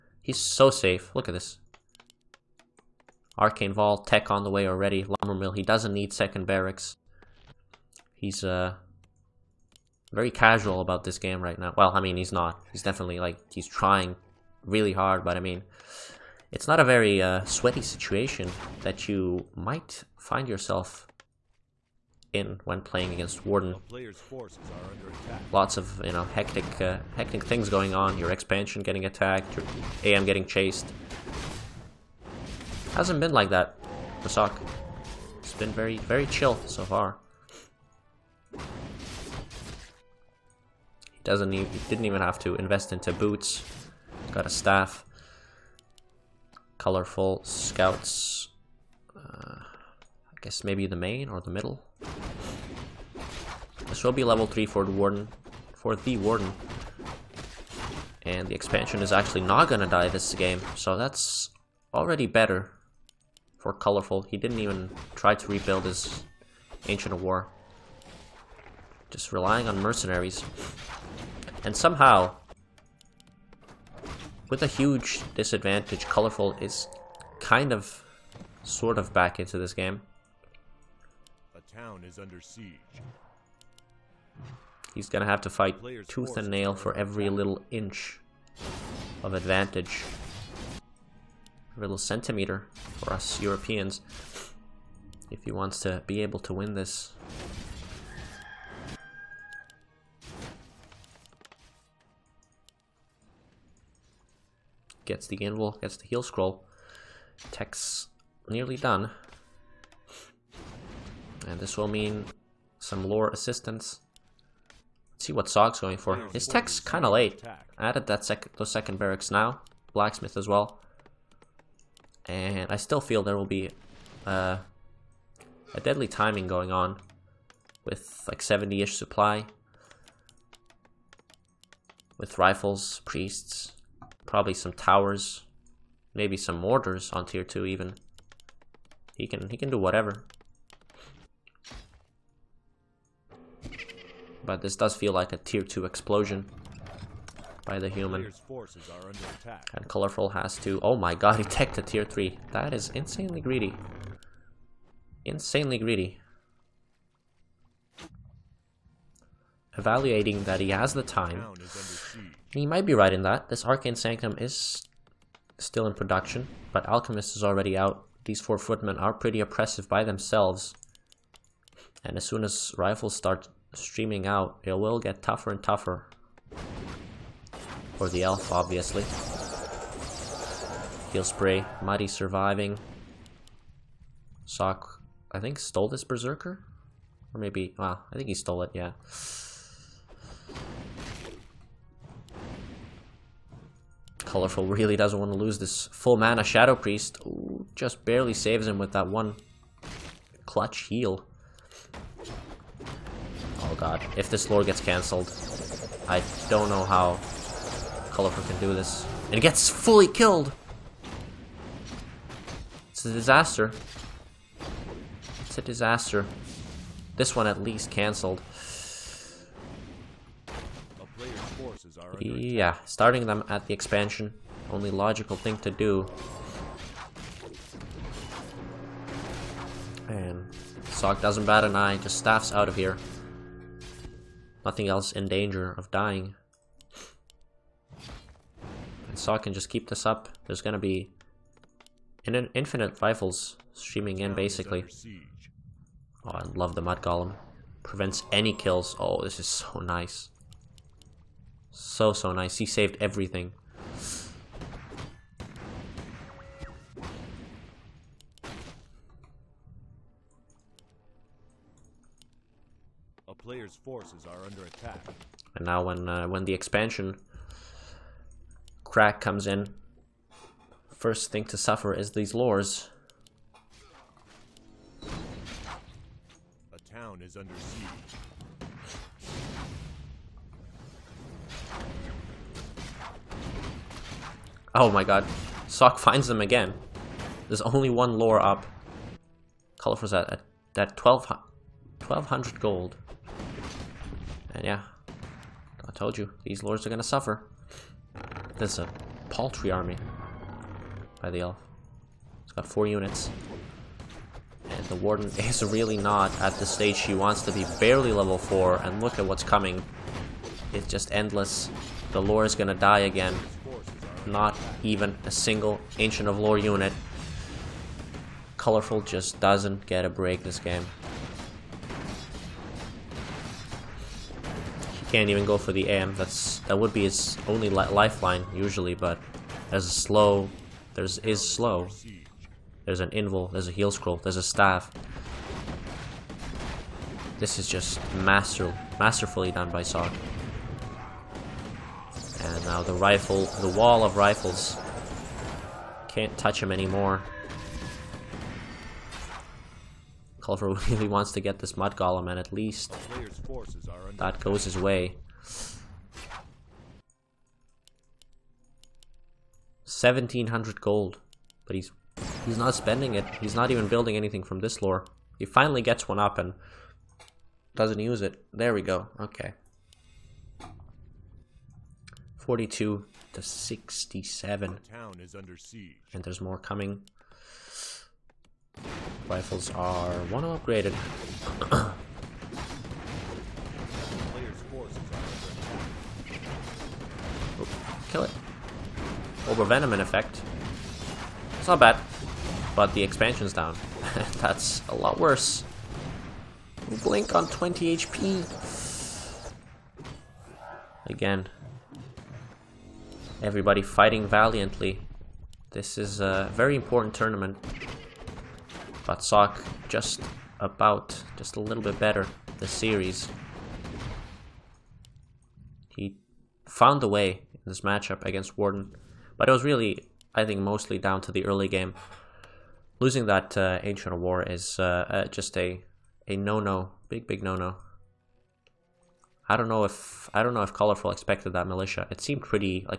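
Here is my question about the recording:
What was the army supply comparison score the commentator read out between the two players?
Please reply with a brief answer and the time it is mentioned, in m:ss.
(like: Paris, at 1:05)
42 to 67, at 6:12.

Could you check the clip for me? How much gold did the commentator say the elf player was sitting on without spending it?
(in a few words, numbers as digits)
1700.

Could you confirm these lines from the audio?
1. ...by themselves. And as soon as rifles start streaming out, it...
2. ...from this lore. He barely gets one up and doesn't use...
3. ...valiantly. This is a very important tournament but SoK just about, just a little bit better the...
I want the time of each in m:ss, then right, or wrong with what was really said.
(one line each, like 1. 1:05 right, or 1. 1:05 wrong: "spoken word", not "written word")
1. 2:49 right
2. 6:04 wrong: "finally", not "barely"
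3. 6:44 right.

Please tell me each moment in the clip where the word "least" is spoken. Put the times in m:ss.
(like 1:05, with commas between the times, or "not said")
3:37, 5:52.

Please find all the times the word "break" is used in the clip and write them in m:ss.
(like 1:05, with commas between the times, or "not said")
5:20.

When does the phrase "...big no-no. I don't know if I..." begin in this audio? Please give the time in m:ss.
7:07.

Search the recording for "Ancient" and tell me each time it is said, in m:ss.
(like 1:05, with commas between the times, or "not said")
1:06, 5:15, 7:03.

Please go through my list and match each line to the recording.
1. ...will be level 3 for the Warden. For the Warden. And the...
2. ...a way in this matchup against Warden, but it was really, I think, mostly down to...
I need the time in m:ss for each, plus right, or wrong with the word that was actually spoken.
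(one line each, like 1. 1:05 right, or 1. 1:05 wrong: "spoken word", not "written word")
1. 0:54 right
2. 6:57 right.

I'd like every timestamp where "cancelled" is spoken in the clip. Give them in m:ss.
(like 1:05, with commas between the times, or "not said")
3:24, 3:37.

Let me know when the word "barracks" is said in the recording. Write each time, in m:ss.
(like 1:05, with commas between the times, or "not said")
0:06, 1:58.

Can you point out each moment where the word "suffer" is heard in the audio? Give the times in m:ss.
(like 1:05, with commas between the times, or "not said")
4:31, 4:57.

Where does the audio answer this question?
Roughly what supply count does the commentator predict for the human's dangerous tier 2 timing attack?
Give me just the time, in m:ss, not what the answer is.
2:08.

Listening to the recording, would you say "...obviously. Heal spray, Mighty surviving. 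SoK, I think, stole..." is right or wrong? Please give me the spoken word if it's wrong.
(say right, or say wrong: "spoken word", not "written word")
right.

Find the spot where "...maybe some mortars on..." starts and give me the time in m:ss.
2:16.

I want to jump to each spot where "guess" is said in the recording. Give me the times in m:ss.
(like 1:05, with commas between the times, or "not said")
0:50.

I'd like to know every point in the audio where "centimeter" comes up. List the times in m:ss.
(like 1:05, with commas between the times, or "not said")
1:31.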